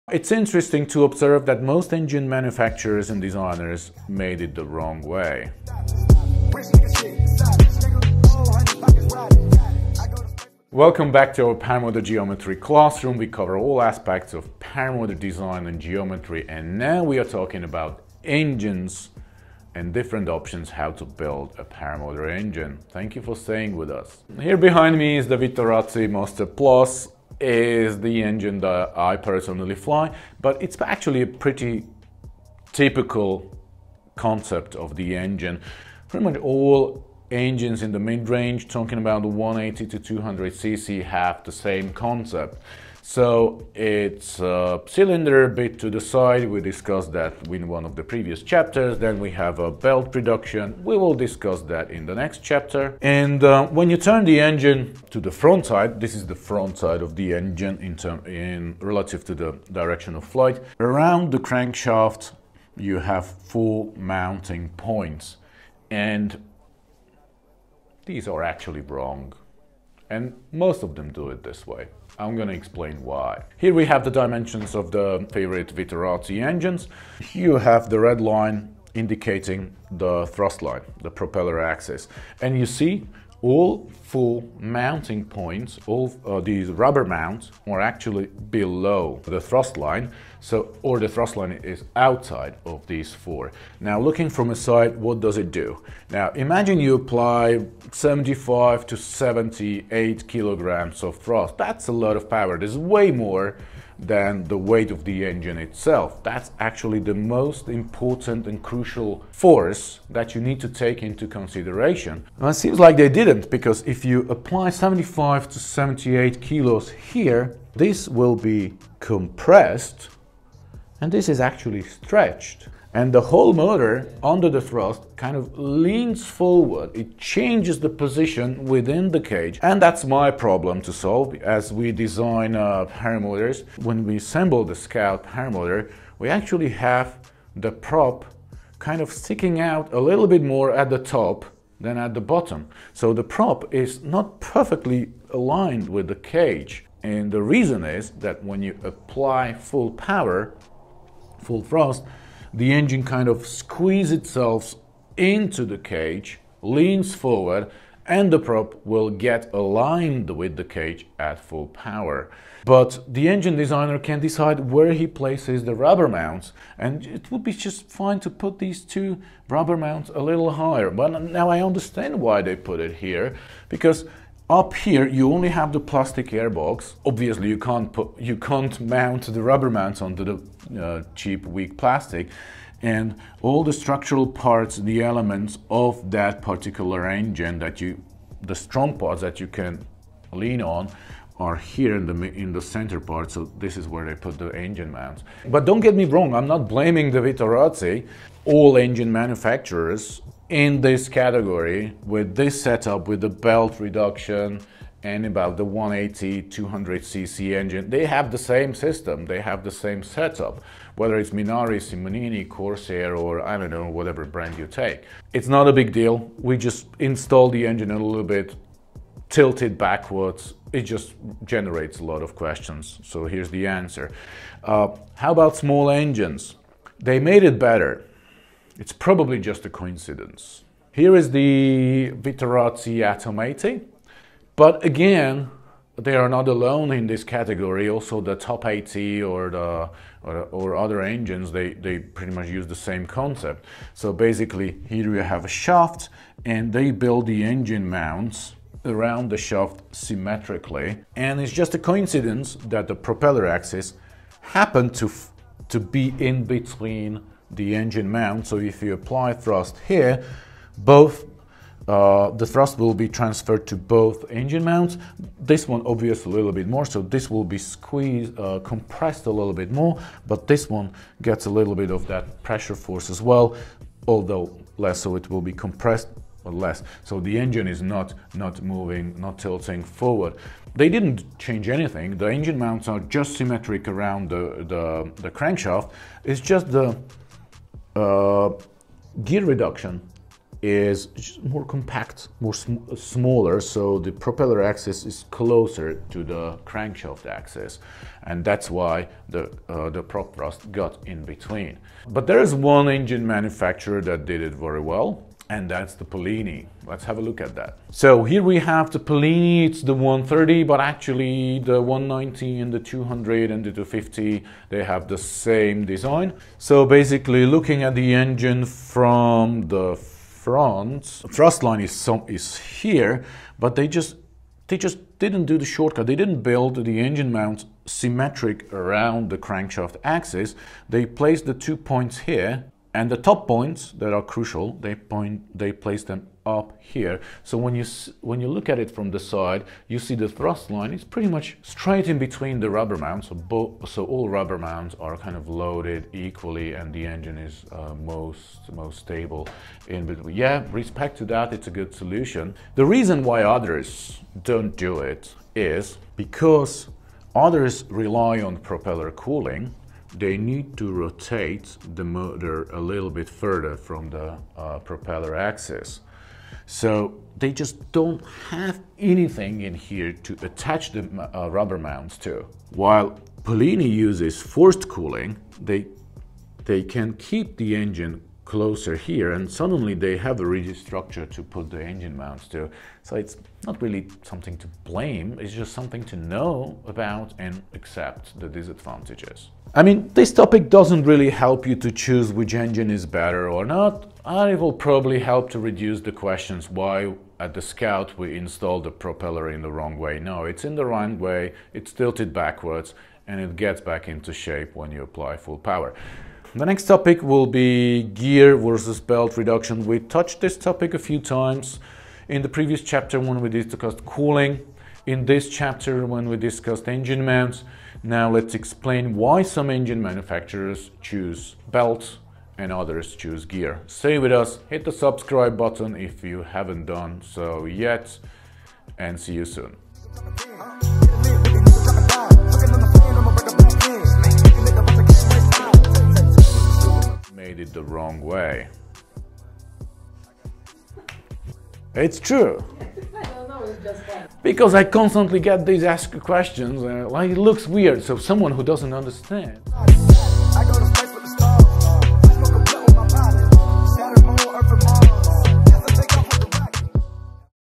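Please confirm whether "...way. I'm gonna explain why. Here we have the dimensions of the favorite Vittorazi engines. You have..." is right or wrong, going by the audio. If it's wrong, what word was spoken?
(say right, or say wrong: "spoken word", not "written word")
right.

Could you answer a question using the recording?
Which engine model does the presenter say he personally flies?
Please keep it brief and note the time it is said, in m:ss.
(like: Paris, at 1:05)
Vittorazi Moster Plus, at 0:25.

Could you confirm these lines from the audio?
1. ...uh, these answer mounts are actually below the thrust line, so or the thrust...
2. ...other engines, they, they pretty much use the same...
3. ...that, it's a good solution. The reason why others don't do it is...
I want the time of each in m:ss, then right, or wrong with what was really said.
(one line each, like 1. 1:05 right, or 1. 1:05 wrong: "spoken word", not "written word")
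1. 1:26 wrong: "rubber", not "answer"
2. 4:00 right
3. 5:51 right.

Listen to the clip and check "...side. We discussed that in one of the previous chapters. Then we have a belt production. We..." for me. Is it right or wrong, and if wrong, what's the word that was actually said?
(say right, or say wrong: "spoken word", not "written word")
right.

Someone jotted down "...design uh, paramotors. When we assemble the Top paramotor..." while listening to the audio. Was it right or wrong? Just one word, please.
wrong.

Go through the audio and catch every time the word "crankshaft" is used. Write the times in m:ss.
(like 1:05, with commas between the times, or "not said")
1:01, 4:45, 4:56, 5:29.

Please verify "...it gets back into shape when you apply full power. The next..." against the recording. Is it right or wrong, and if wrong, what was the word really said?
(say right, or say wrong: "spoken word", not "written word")
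right.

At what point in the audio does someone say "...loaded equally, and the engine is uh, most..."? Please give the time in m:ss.
5:45.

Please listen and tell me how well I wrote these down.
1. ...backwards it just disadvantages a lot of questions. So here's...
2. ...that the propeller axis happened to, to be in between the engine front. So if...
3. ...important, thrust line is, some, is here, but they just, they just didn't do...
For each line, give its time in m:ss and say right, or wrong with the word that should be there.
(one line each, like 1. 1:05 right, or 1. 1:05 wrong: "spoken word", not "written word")
1. 3:39 wrong: "generates", not "disadvantages"
2. 4:12 wrong: "mount", not "front"
3. 5:19 wrong: "front", not "important".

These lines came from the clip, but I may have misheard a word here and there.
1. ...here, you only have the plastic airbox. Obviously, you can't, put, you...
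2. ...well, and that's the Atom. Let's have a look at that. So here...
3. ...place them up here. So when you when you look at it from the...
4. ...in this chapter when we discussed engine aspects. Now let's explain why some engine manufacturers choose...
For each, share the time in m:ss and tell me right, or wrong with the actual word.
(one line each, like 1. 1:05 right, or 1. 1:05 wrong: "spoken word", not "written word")
1. 2:54 right
2. 5:04 wrong: "Polini", not "Atom"
3. 5:35 right
4. 6:55 wrong: "mounts", not "aspects".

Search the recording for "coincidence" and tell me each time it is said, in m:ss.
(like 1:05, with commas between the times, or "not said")
3:49, 4:11.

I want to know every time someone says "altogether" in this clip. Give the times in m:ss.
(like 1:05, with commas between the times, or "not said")
not said.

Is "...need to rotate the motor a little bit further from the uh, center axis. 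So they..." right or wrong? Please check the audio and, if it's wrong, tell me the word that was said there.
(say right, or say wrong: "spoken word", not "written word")
wrong: "propeller", not "center".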